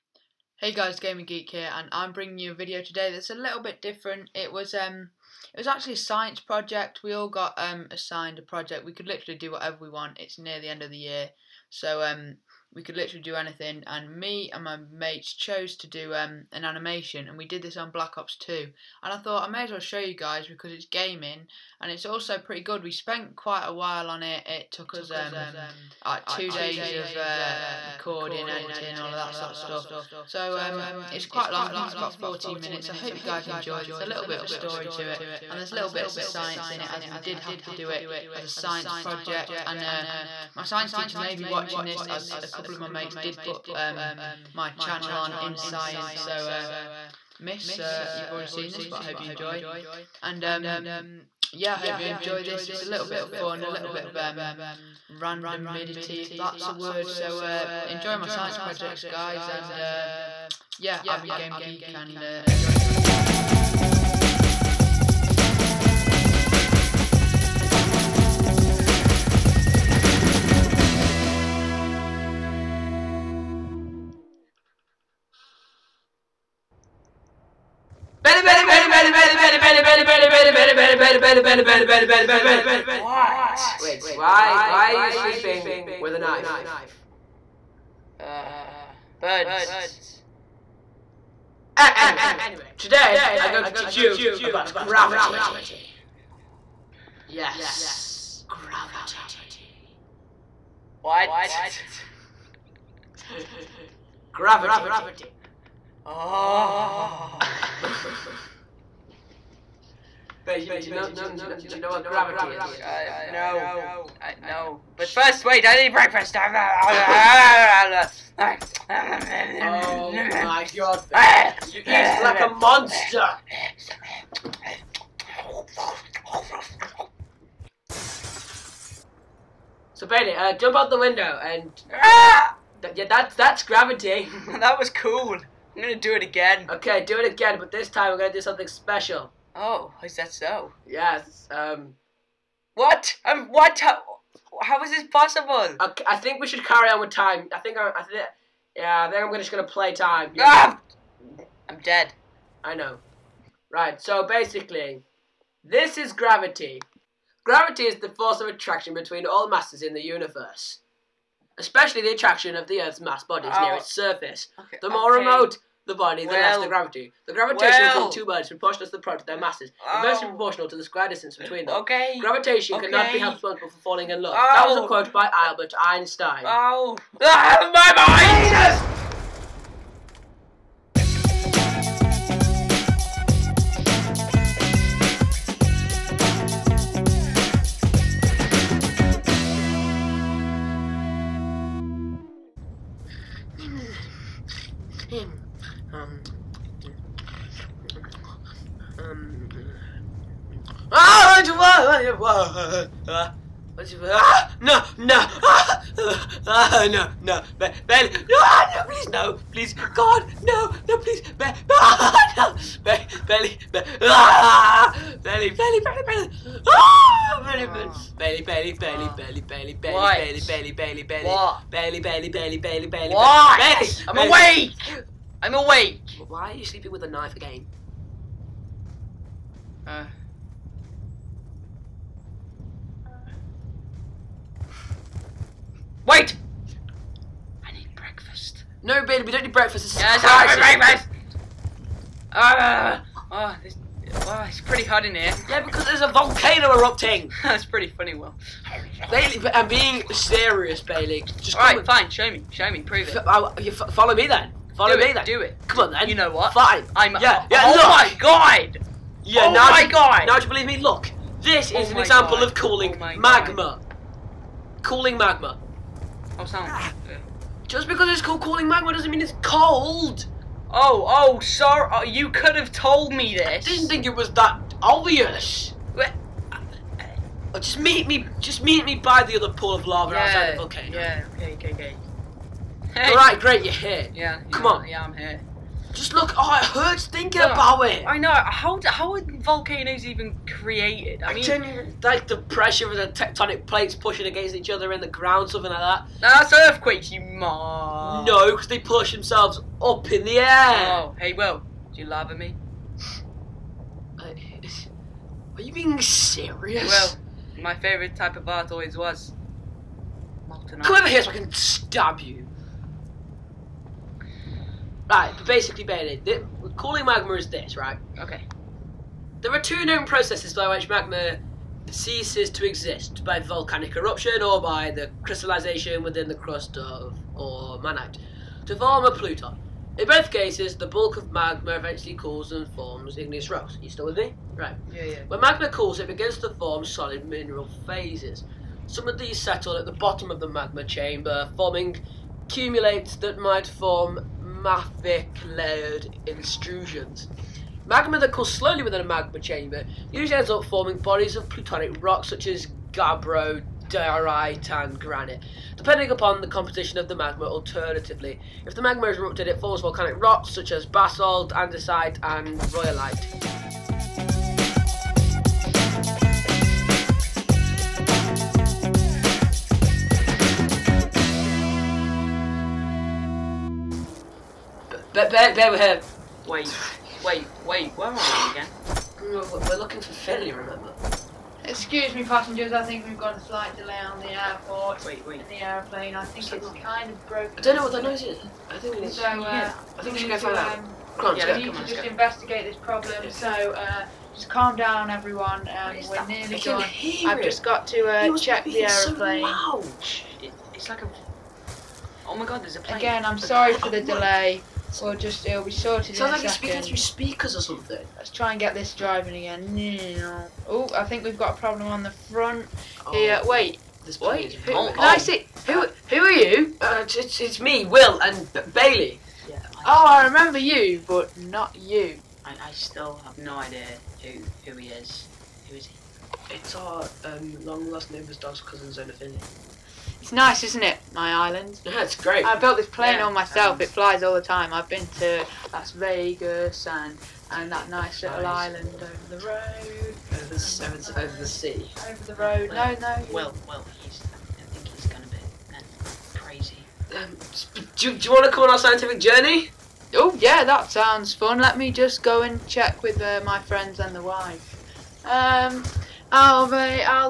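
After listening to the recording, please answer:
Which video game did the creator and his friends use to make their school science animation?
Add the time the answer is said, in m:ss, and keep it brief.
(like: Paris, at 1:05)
Black Ops 2, at 0:17.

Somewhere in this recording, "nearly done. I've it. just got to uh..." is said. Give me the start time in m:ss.
6:36.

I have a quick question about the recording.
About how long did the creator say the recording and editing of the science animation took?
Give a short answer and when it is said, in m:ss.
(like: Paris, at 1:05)
two days, at 0:26.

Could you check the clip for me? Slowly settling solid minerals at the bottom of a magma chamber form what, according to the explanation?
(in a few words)
cumulates.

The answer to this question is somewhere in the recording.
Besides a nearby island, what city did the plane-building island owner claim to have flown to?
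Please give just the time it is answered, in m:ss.
7:15.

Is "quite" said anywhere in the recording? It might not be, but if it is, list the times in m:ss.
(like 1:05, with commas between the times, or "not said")
0:23, 0:31.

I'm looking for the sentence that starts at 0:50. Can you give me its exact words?
And um, yeah, I hope you enjoy this.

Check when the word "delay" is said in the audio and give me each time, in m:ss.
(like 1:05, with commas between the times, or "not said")
6:23, 6:43.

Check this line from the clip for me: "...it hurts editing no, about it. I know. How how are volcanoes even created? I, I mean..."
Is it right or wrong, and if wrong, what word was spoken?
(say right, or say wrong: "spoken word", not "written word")
wrong: "thinking", not "editing".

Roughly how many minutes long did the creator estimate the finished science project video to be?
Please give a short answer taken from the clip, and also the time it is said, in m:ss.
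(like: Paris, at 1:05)
14, at 0:32.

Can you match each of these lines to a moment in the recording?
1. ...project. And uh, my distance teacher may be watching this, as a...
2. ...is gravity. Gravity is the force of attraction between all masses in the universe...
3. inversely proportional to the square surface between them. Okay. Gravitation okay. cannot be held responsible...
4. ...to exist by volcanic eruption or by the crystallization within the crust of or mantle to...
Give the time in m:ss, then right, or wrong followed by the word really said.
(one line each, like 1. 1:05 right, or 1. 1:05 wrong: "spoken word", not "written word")
1. 0:38 wrong: "science", not "distance"
2. 2:35 right
3. 2:49 wrong: "distance", not "surface"
4. 5:22 right.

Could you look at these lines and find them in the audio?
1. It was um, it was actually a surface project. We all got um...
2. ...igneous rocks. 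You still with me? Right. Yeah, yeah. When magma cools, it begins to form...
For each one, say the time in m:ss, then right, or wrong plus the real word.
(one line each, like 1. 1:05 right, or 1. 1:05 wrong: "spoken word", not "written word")
1. 0:04 wrong: "science", not "surface"
2. 5:33 right.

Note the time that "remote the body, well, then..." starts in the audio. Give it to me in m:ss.
2:45.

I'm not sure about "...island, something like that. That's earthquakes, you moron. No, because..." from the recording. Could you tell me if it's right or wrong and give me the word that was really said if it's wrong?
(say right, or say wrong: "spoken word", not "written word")
wrong: "ground", not "island".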